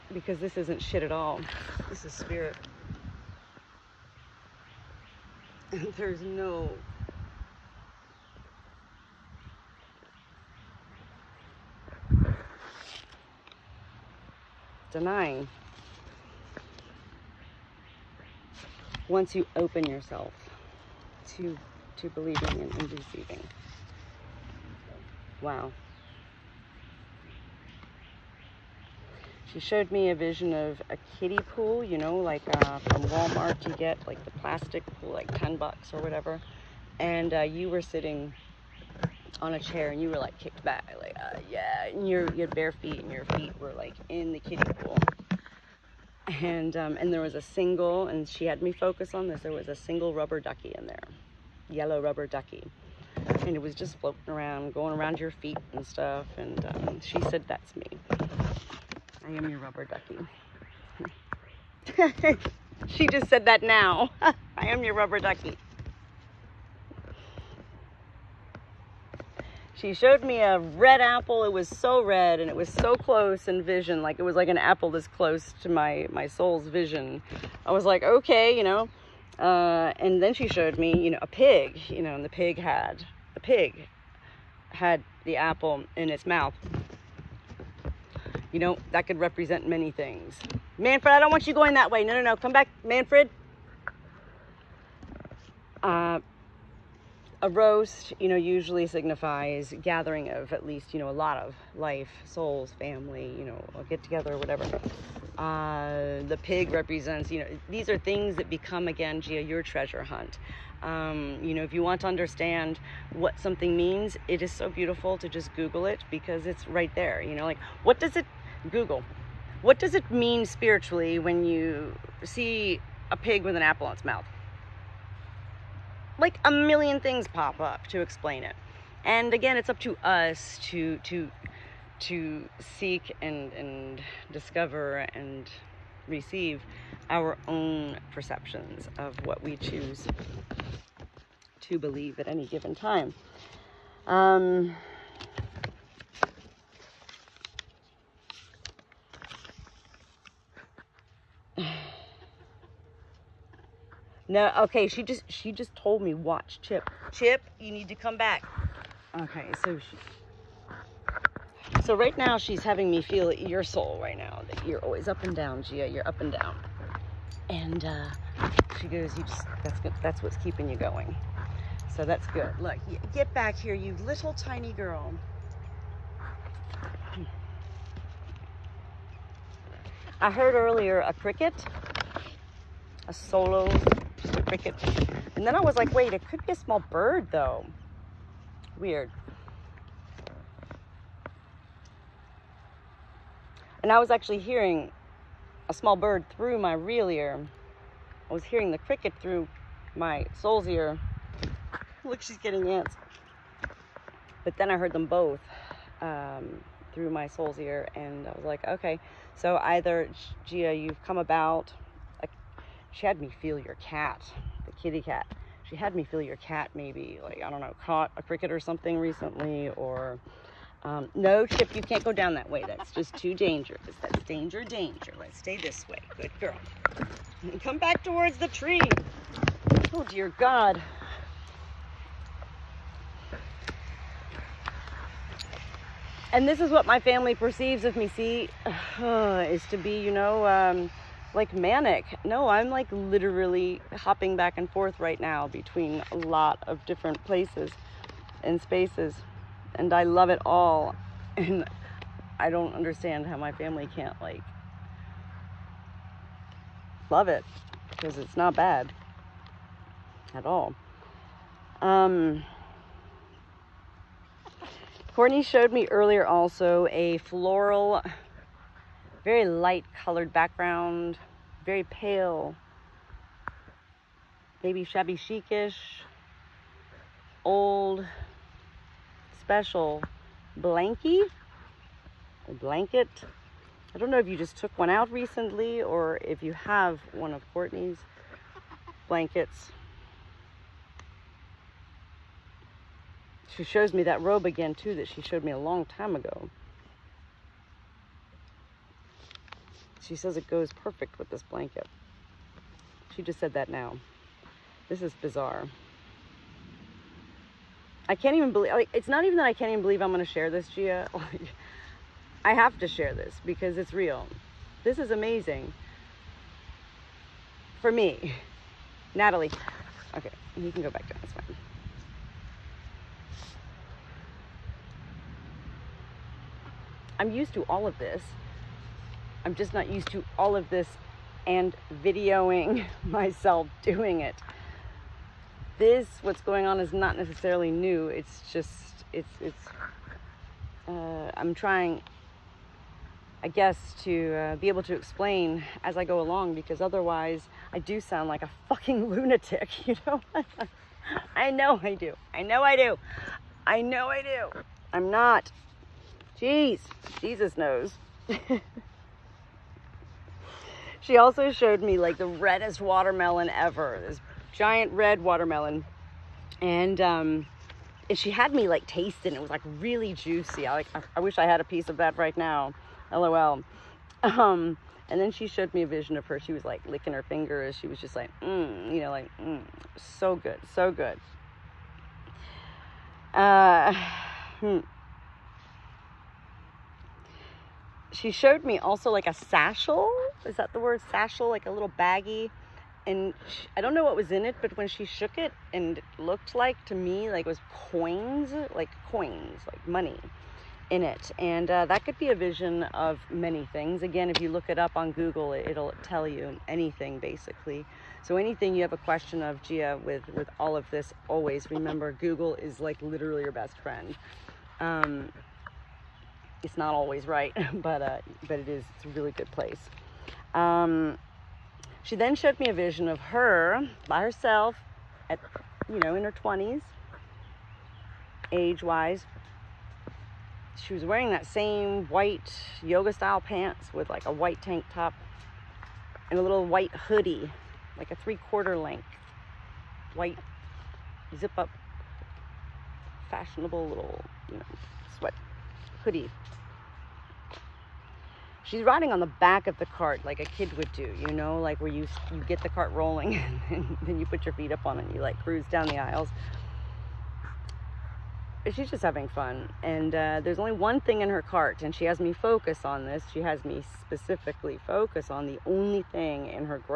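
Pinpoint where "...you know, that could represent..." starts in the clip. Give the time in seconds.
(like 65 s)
88 s.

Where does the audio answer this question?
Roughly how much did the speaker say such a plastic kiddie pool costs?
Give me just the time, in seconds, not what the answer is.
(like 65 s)
35 s.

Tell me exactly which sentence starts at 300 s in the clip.
She says it goes perfect with this blanket.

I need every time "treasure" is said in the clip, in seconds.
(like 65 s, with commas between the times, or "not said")
109 s.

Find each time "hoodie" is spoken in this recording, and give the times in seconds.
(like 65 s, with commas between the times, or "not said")
436 s, 446 s.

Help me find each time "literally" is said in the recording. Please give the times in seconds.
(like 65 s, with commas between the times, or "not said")
242 s, 413 s.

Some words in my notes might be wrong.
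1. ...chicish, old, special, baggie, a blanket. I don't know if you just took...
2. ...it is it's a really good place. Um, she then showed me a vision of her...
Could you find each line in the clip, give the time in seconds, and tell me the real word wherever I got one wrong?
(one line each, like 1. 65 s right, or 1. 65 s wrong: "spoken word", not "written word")
1. 275 s wrong: "blankie", not "baggie"
2. 418 s right.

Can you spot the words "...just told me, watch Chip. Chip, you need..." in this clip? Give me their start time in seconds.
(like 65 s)
155 s.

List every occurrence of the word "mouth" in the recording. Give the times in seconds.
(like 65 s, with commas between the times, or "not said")
86 s, 124 s.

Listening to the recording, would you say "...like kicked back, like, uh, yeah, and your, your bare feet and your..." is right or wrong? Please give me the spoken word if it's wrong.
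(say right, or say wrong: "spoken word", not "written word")
right.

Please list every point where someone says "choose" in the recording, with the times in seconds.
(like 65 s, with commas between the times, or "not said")
139 s.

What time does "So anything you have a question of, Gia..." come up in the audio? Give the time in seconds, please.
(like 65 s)
408 s.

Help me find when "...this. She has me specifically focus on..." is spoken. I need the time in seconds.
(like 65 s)
463 s.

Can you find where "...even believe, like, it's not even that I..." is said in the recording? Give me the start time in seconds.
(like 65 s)
308 s.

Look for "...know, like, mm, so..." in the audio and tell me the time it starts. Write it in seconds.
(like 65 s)
379 s.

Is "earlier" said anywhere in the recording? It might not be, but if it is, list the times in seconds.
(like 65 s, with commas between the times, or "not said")
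180 s, 265 s.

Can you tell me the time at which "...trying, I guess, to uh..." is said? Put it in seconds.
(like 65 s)
341 s.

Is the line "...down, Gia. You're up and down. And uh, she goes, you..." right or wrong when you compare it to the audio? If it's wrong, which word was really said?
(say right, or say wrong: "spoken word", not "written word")
right.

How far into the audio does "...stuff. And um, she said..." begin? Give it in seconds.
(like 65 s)
55 s.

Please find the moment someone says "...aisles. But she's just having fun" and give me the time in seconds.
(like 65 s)
455 s.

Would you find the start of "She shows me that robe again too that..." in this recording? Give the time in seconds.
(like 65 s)
293 s.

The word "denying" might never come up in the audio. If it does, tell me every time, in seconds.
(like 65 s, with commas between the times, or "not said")
14 s.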